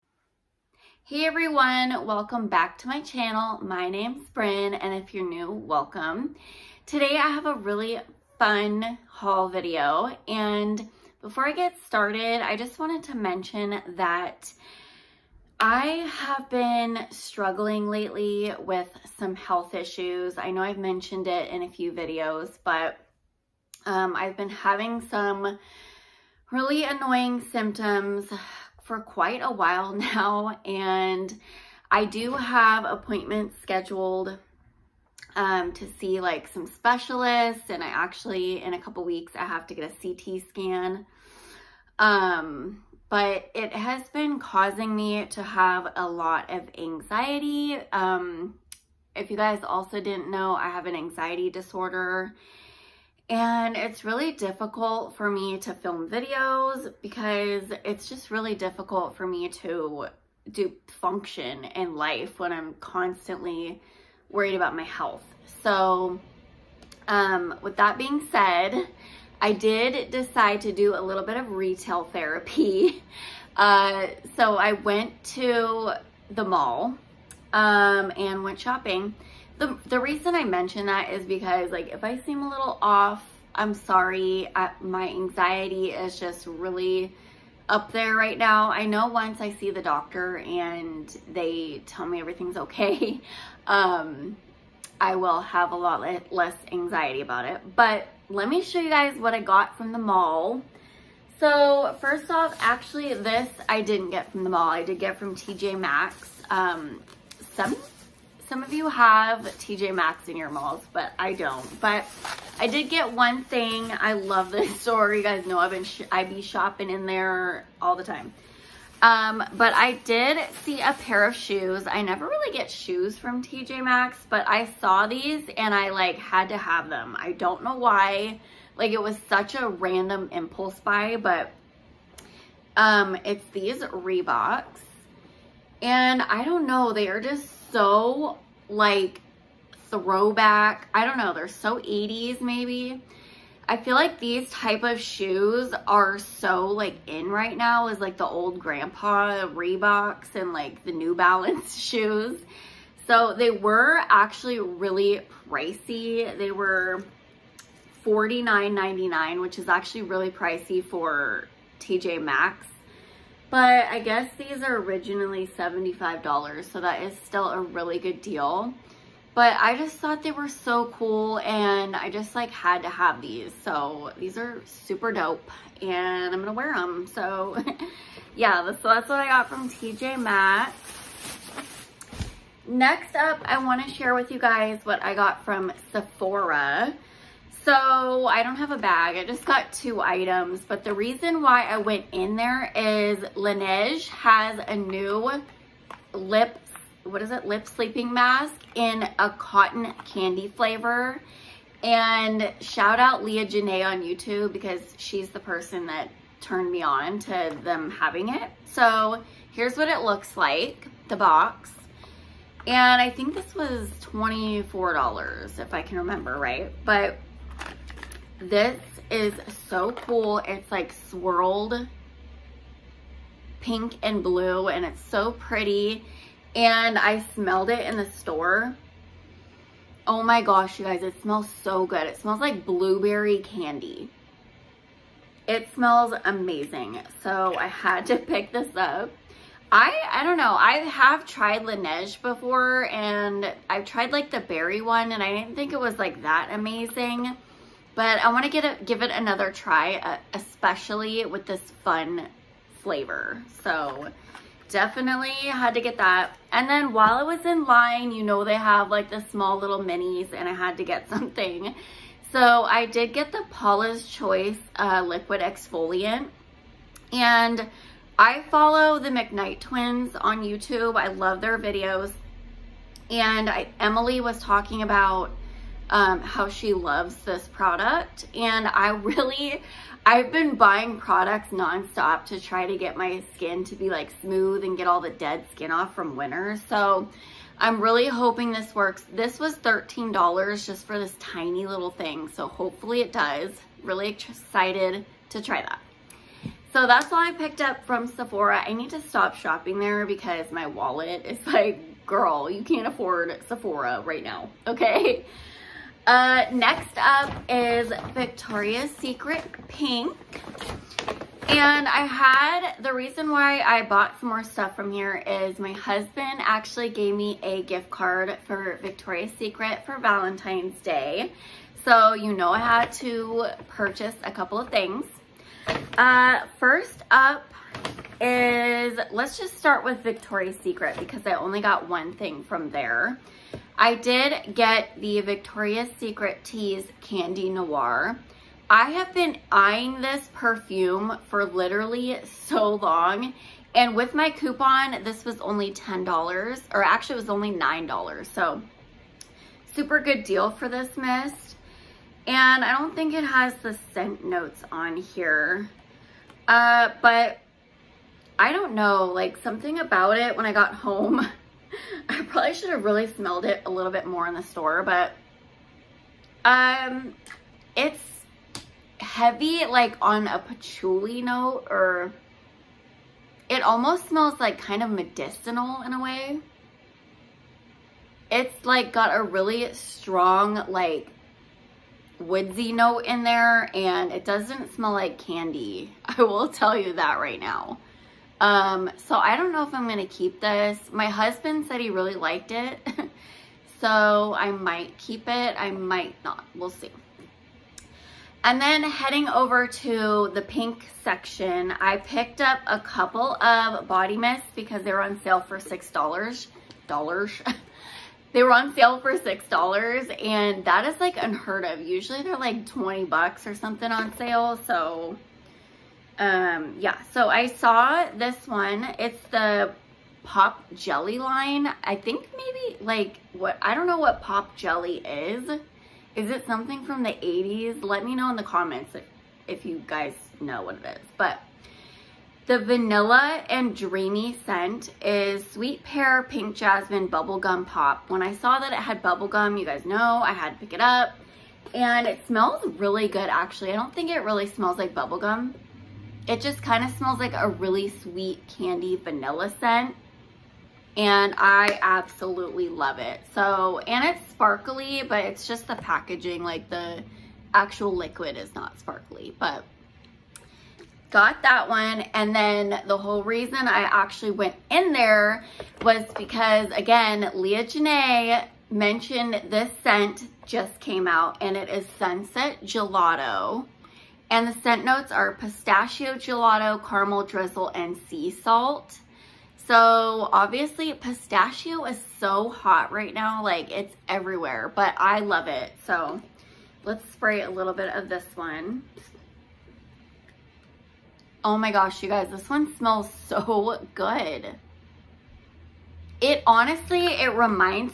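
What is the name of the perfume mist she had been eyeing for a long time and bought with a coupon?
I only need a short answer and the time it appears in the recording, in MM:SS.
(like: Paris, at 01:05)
Tease Candy Noir, at 05:36.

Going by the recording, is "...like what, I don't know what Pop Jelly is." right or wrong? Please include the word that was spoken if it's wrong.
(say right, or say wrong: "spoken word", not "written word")
right.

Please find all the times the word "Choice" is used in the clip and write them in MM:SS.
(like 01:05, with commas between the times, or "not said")
04:24.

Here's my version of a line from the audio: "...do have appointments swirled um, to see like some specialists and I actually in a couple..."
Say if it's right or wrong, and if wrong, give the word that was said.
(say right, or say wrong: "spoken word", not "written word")
wrong: "scheduled", not "swirled".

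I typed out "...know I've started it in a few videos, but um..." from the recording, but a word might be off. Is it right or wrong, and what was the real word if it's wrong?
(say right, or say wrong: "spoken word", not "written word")
wrong: "mentioned", not "started".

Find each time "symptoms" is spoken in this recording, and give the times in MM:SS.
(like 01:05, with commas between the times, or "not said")
00:27.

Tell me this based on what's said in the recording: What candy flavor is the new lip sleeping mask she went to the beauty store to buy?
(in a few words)
cotton candy.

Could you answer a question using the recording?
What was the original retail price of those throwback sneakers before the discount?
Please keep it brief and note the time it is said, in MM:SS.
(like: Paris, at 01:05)
$75, at 02:45.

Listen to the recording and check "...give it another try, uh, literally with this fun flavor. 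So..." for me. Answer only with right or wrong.
wrong.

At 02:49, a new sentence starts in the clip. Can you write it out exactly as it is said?
But I just thought they were so cool and I just like had to have these.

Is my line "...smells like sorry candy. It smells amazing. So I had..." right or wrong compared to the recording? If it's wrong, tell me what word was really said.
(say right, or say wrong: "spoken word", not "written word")
wrong: "blueberry", not "sorry".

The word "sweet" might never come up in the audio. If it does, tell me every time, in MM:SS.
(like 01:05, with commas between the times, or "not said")
07:15, 07:27.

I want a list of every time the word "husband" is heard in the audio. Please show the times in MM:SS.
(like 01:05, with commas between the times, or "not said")
05:15, 06:31.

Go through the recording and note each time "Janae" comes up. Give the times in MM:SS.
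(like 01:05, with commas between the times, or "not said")
03:23, 07:47.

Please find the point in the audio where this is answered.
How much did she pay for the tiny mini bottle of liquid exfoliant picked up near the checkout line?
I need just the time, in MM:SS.
04:49.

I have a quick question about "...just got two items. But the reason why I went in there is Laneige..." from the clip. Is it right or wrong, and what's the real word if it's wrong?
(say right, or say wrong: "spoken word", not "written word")
right.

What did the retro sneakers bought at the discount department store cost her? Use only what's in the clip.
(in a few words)
$49.99.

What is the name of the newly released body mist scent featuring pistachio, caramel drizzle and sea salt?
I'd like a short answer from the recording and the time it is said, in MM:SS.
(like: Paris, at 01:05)
Sunset Gelato, at 07:51.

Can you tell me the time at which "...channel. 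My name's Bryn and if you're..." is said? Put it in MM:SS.
00:02.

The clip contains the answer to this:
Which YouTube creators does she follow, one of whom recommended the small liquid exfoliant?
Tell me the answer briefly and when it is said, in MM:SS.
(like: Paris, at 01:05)
McKnight twins, at 04:29.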